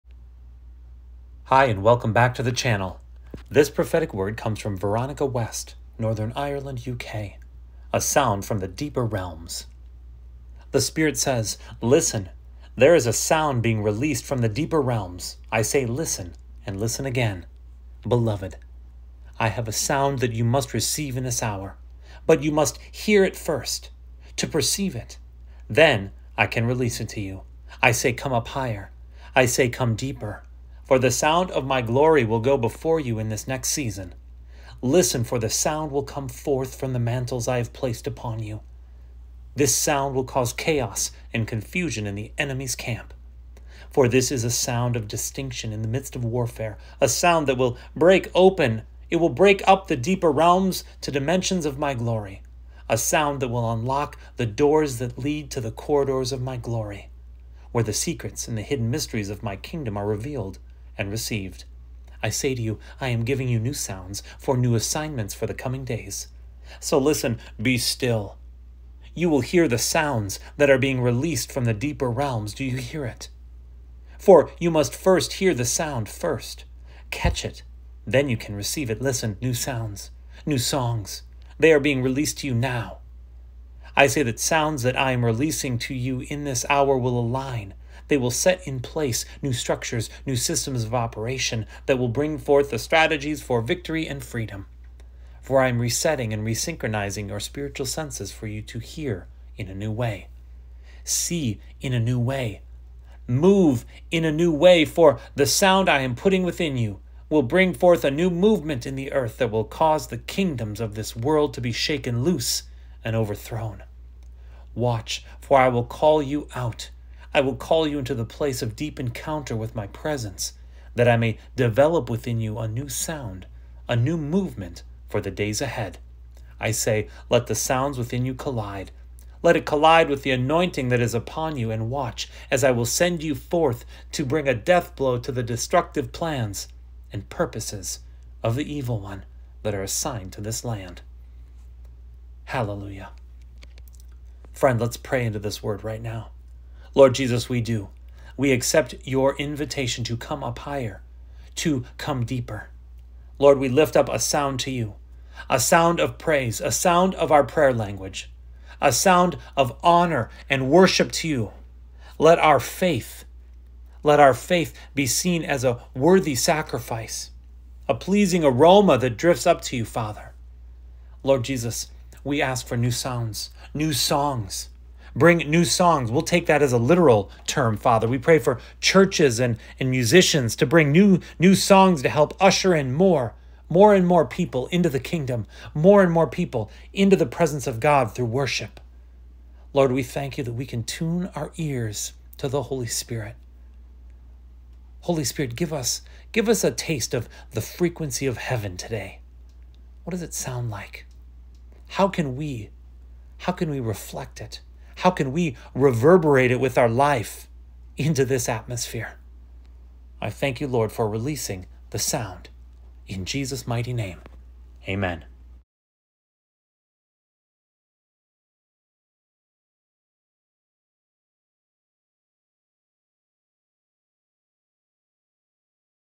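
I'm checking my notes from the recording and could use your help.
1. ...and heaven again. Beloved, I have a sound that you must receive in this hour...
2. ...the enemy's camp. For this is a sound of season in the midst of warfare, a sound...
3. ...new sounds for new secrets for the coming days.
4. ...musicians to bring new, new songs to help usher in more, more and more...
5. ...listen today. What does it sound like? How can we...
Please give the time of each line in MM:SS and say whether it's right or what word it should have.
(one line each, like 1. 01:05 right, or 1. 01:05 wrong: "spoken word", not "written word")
1. 00:16 wrong: "listen", not "heaven"
2. 00:42 wrong: "distinction", not "season"
3. 01:03 wrong: "assignments", not "secrets"
4. 02:59 right
5. 03:18 wrong: "heaven", not "listen".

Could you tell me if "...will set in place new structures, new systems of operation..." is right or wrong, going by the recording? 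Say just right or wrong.
right.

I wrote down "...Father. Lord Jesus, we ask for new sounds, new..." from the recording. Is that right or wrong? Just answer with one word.
right.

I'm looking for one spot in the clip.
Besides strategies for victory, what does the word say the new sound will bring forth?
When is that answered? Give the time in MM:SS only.
01:34.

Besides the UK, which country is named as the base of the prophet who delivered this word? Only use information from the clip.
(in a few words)
Northern Ireland.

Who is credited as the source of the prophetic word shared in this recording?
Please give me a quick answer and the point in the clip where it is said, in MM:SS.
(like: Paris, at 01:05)
Veronika West, at 00:04.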